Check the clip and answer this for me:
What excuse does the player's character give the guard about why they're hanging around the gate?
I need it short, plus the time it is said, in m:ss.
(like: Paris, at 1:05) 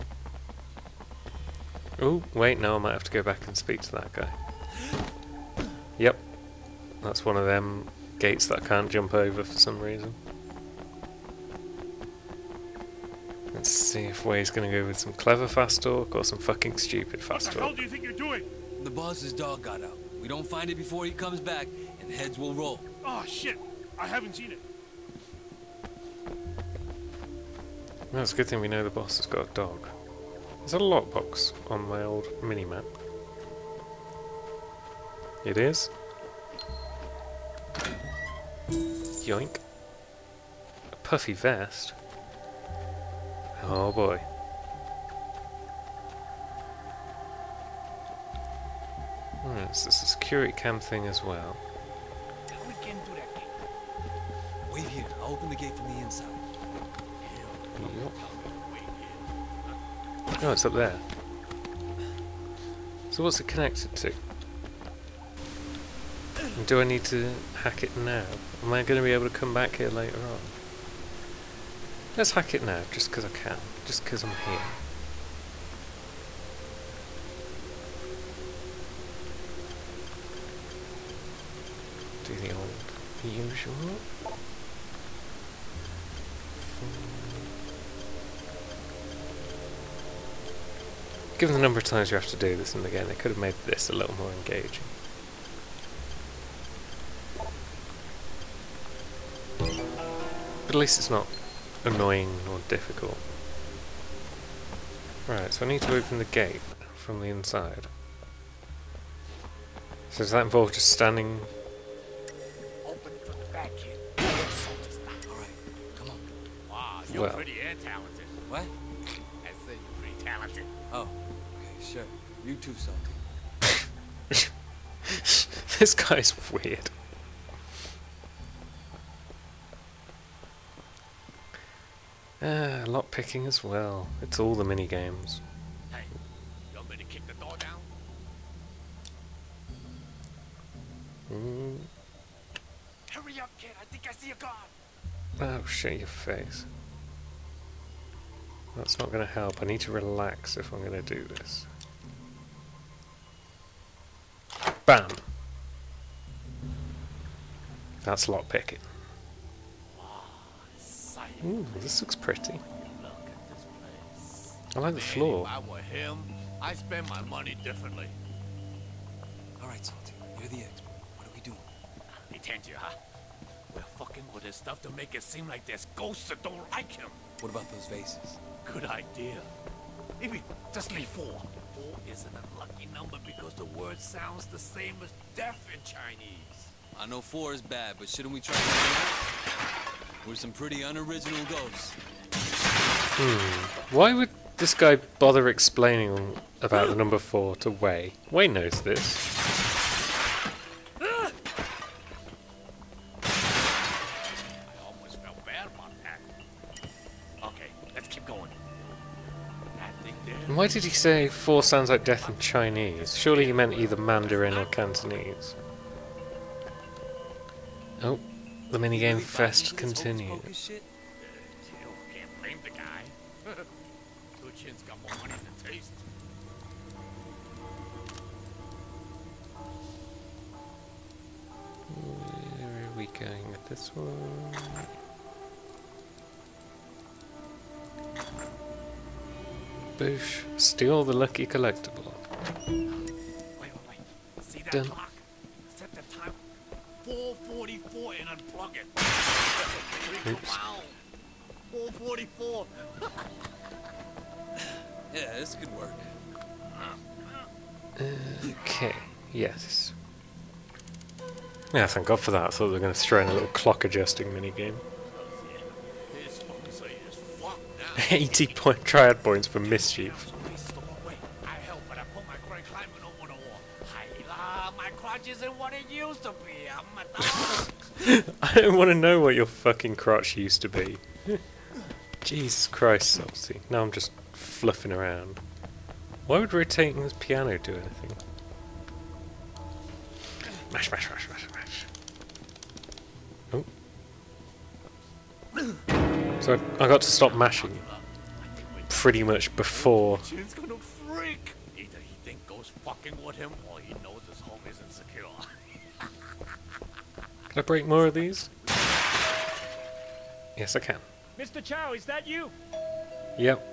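The boss's dog got out, at 0:18.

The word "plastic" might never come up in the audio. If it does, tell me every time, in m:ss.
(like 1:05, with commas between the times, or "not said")
not said.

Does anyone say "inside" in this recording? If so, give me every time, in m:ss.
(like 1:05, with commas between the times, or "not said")
0:56, 1:47.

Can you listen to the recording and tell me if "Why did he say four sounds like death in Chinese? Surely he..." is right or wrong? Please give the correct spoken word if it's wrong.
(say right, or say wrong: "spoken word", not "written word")
right.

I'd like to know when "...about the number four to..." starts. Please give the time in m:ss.
3:16.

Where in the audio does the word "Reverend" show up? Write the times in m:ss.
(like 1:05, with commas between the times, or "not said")
not said.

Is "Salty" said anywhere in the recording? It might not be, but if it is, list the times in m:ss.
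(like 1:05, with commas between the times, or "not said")
2:02, 2:49, 4:43.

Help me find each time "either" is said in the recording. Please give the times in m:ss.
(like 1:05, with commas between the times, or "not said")
3:33, 5:01.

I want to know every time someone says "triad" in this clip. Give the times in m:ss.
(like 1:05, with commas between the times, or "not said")
4:28.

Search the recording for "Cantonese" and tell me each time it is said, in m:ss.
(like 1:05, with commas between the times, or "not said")
3:34.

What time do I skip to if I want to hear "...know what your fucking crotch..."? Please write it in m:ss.
4:38.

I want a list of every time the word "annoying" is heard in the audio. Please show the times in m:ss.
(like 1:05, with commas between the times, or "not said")
1:41.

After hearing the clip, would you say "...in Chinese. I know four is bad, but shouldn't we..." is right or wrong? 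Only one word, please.
right.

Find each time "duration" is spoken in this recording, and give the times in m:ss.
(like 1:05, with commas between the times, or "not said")
not said.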